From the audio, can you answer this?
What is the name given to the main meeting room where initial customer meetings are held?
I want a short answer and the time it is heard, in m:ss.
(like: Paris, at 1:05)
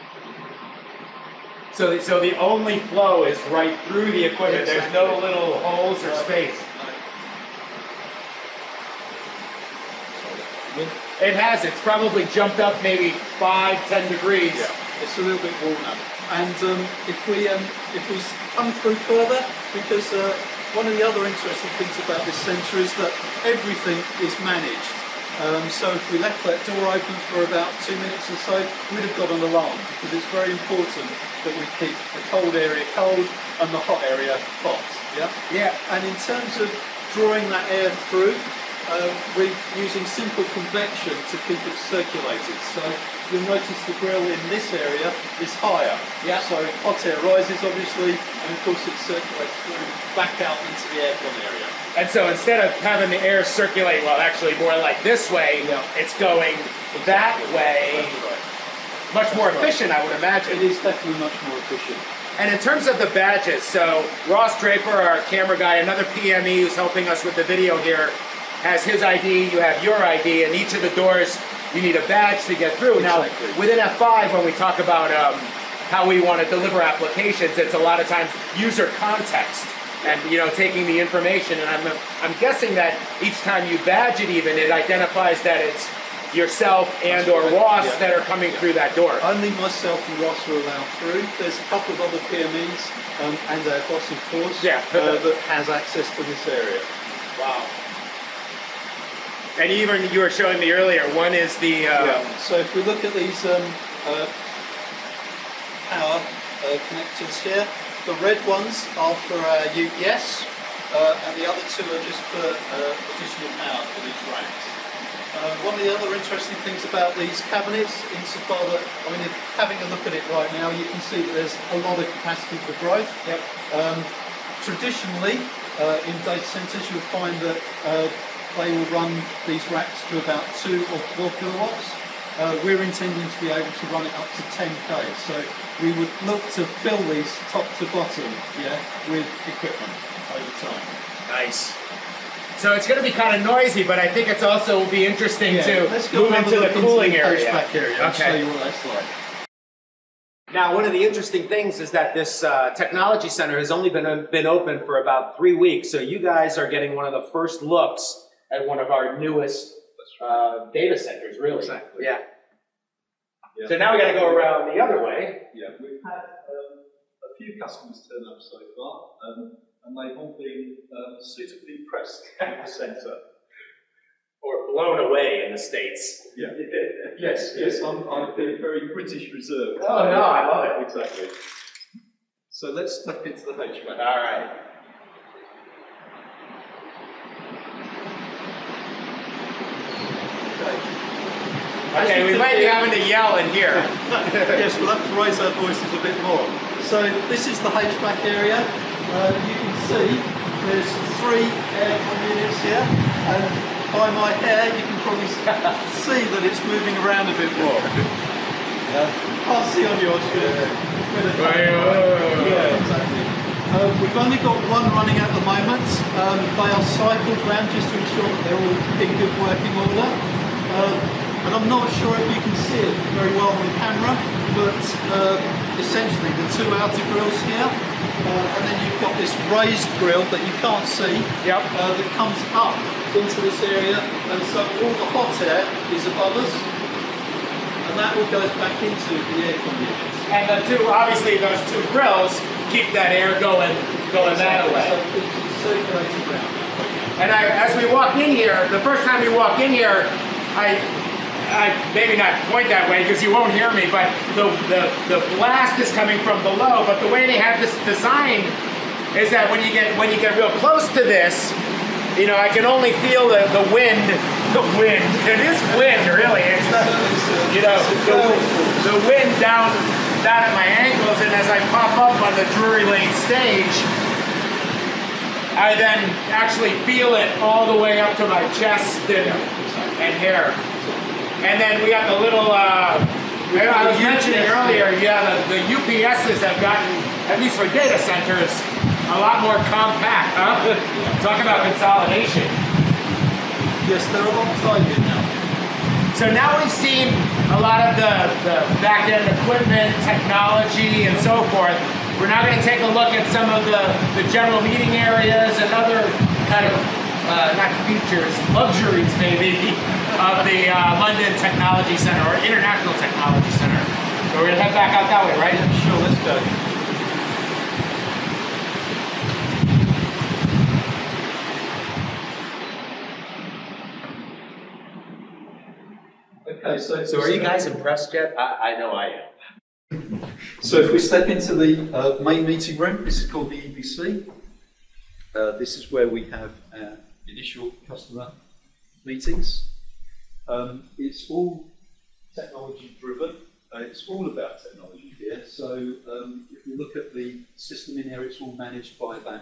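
EBC, at 5:33.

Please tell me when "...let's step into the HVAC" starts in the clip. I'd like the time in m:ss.
3:02.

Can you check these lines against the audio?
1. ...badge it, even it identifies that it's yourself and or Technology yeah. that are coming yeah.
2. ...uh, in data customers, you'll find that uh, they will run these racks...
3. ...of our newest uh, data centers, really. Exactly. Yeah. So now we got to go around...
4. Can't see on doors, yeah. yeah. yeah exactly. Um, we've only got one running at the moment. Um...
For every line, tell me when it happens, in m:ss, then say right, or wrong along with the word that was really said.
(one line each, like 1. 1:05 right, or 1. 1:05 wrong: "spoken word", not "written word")
1. 1:23 wrong: "Ross", not "Technology"
2. 2:05 wrong: "centers", not "customers"
3. 2:38 right
4. 3:29 wrong: "yours", not "doors".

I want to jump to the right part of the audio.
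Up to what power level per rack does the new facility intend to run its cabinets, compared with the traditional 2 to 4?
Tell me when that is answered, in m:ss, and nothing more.
2:14.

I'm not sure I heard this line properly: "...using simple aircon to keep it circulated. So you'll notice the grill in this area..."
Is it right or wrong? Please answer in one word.
wrong.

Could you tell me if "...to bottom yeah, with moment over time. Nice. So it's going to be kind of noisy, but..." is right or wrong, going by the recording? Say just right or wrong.
wrong.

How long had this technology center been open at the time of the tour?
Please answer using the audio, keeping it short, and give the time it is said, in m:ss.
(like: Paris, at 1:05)
About 3 weeks, at 2:35.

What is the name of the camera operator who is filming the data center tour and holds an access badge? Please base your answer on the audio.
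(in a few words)
Ross Draper.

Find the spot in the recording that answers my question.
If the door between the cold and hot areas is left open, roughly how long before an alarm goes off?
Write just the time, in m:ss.
0:27.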